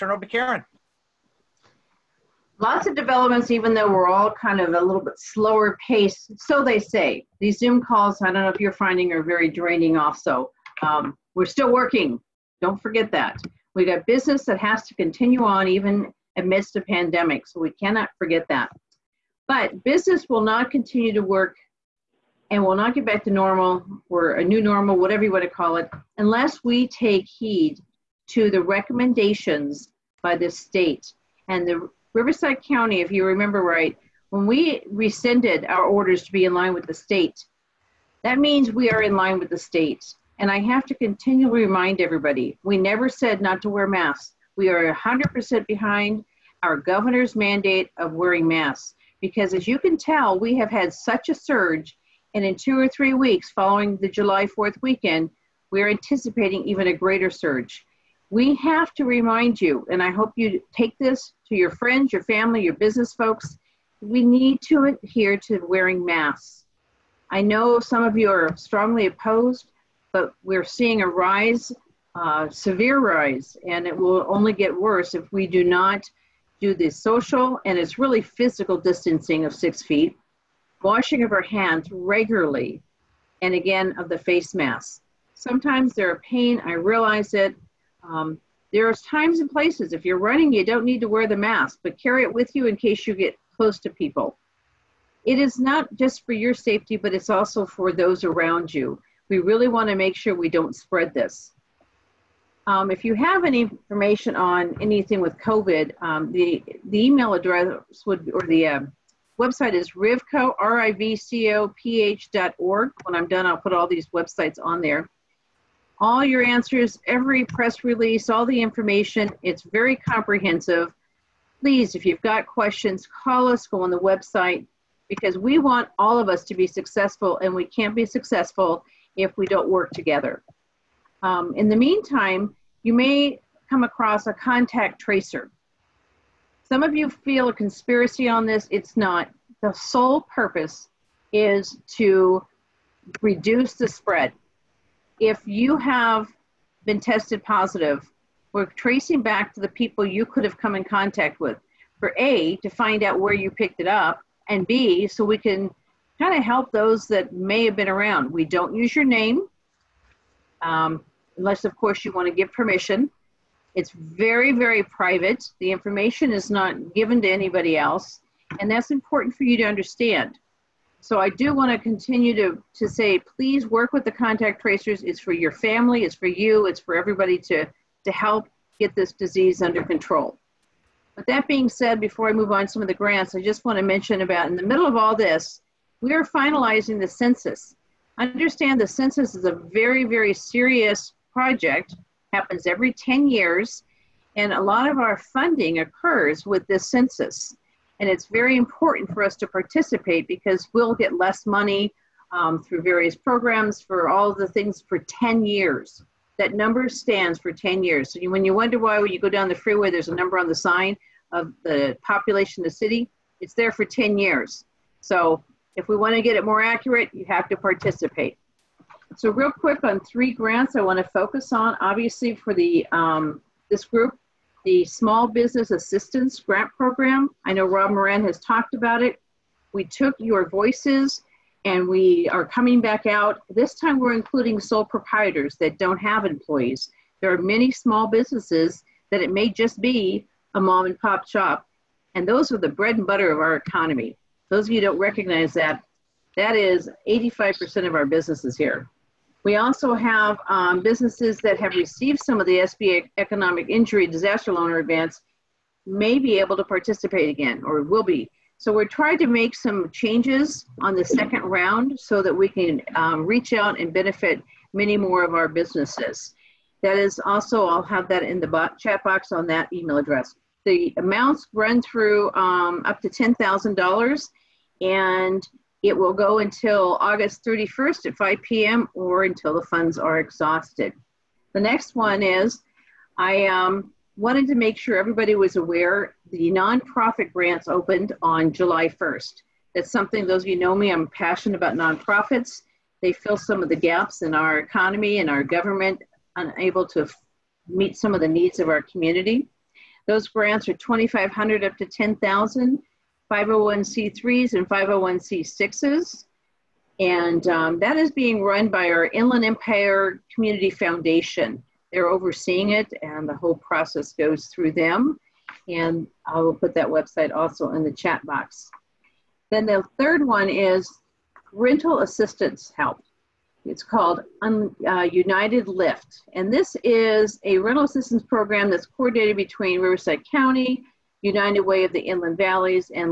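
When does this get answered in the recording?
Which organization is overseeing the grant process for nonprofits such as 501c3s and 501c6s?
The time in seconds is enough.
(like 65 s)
309 s.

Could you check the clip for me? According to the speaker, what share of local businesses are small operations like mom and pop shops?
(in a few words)
85%.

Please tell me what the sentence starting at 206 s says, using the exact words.
That number stands for 10 years.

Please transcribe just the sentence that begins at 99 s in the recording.
We really want to make sure we don't spread this.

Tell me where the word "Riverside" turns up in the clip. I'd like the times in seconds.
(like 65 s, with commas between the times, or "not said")
32 s, 329 s.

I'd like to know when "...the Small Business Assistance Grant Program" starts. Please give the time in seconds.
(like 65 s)
224 s.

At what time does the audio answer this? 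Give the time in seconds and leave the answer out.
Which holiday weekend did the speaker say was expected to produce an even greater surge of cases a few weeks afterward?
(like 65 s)
54 s.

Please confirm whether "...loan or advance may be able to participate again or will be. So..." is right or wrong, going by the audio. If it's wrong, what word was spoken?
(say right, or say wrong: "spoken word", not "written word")
right.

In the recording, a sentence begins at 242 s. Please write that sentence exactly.
And those are the bread and butter of our economy.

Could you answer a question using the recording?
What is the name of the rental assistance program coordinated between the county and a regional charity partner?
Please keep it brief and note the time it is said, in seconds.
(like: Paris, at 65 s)
United Lift, at 325 s.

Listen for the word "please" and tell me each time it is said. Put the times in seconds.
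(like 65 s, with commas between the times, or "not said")
121 s, 173 s.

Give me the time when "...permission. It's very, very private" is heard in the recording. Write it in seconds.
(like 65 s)
162 s.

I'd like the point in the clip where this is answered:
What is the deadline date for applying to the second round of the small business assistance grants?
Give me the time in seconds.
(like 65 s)
276 s.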